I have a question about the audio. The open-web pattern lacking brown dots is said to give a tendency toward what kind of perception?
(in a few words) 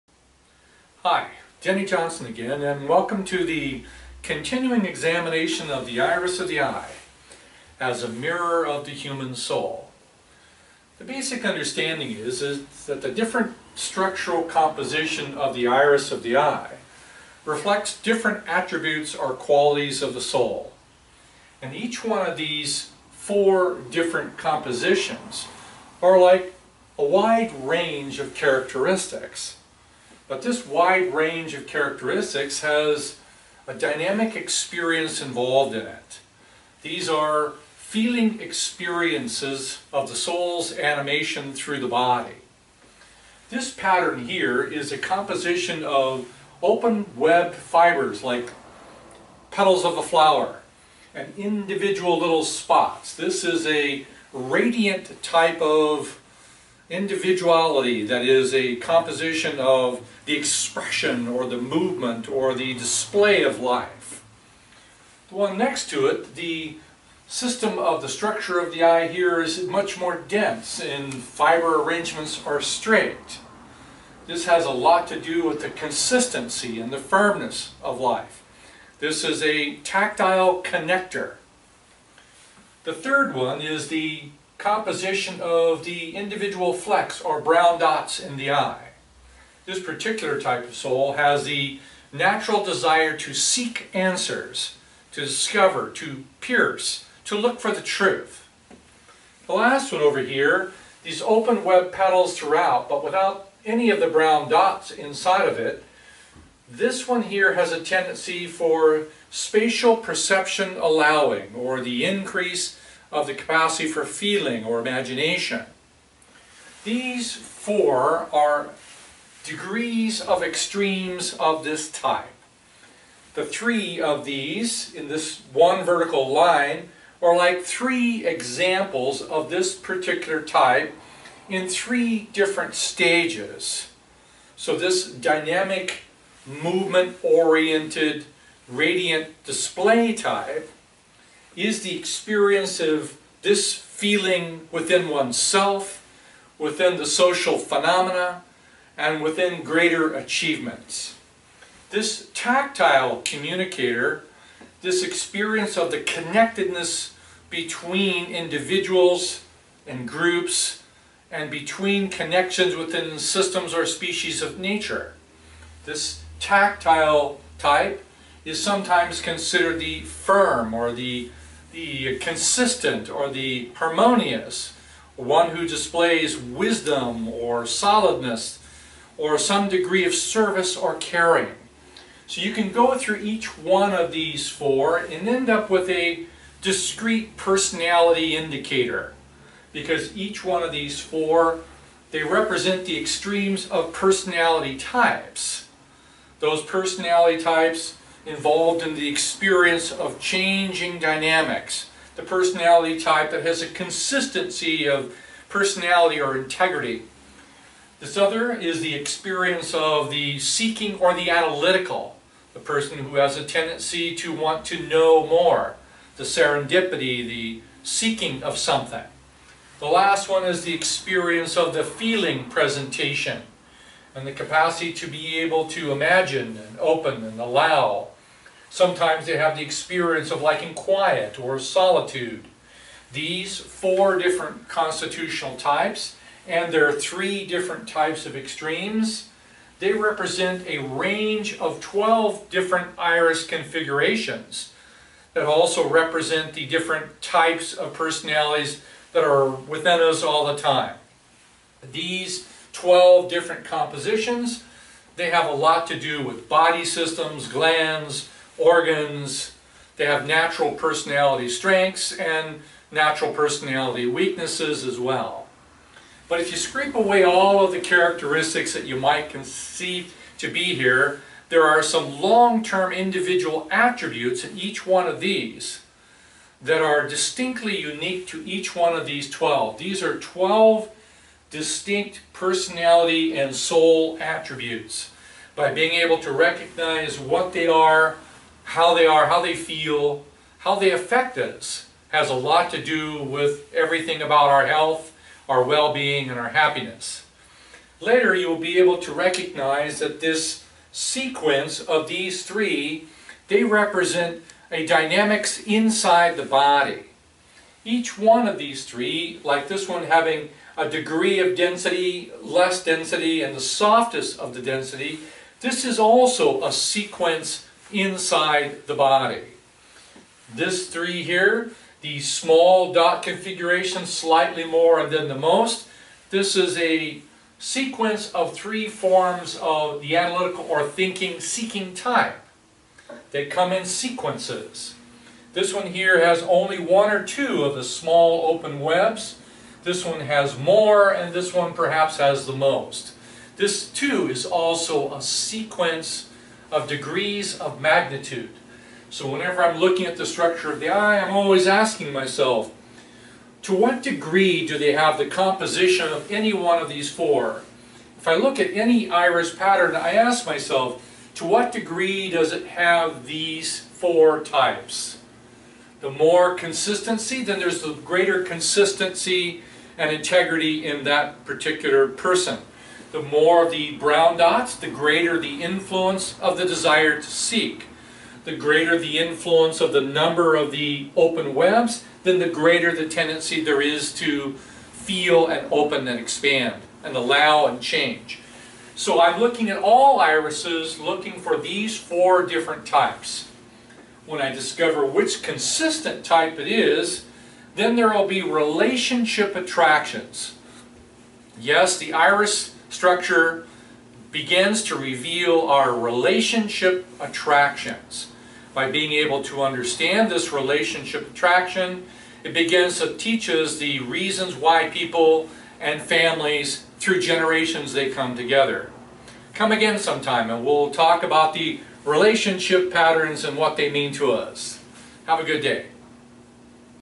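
spatial perception.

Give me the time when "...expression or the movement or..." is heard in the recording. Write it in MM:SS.
01:00.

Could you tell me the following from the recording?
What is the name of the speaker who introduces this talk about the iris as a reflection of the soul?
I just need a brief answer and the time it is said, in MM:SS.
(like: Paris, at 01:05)
Denny Johnson, at 00:01.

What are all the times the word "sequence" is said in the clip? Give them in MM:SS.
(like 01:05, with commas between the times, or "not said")
05:00, 05:16, 05:27, 05:33, 05:45.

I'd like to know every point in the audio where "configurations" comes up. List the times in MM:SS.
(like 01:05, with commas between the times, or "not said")
04:03, 05:23.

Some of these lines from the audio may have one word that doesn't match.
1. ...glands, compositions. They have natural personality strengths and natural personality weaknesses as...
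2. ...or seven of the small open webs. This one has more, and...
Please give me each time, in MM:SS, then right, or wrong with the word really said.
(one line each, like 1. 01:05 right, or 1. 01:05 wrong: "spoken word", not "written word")
1. 04:17 wrong: "organs", not "compositions"
2. 05:37 wrong: "two", not "seven".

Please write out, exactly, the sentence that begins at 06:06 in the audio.
the more consistency, then there's the greater consistency and integrity in that particular person.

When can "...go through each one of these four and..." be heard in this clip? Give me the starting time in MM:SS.
03:02.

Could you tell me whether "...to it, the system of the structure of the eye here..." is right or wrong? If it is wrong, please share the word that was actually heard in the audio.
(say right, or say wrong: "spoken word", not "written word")
right.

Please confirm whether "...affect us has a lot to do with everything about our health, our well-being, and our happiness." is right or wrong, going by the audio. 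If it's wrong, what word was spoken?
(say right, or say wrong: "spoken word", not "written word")
right.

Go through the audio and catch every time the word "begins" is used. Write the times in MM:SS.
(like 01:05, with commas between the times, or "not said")
06:44, 06:52.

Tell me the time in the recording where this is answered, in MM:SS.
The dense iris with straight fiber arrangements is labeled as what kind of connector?
01:19.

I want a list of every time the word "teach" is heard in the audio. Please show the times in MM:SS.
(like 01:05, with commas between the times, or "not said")
06:53.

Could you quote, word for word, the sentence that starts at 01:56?
These four are degrees of extremes of this type.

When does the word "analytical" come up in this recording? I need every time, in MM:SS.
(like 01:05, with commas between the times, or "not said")
03:31, 05:30.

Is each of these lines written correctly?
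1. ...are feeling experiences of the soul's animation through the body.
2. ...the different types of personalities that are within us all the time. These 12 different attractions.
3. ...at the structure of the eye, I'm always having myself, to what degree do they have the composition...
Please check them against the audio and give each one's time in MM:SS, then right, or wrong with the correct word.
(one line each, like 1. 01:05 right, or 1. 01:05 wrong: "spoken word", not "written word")
1. 00:37 right
2. 04:06 wrong: "compositions", not "attractions"
3. 05:50 wrong: "asking", not "having".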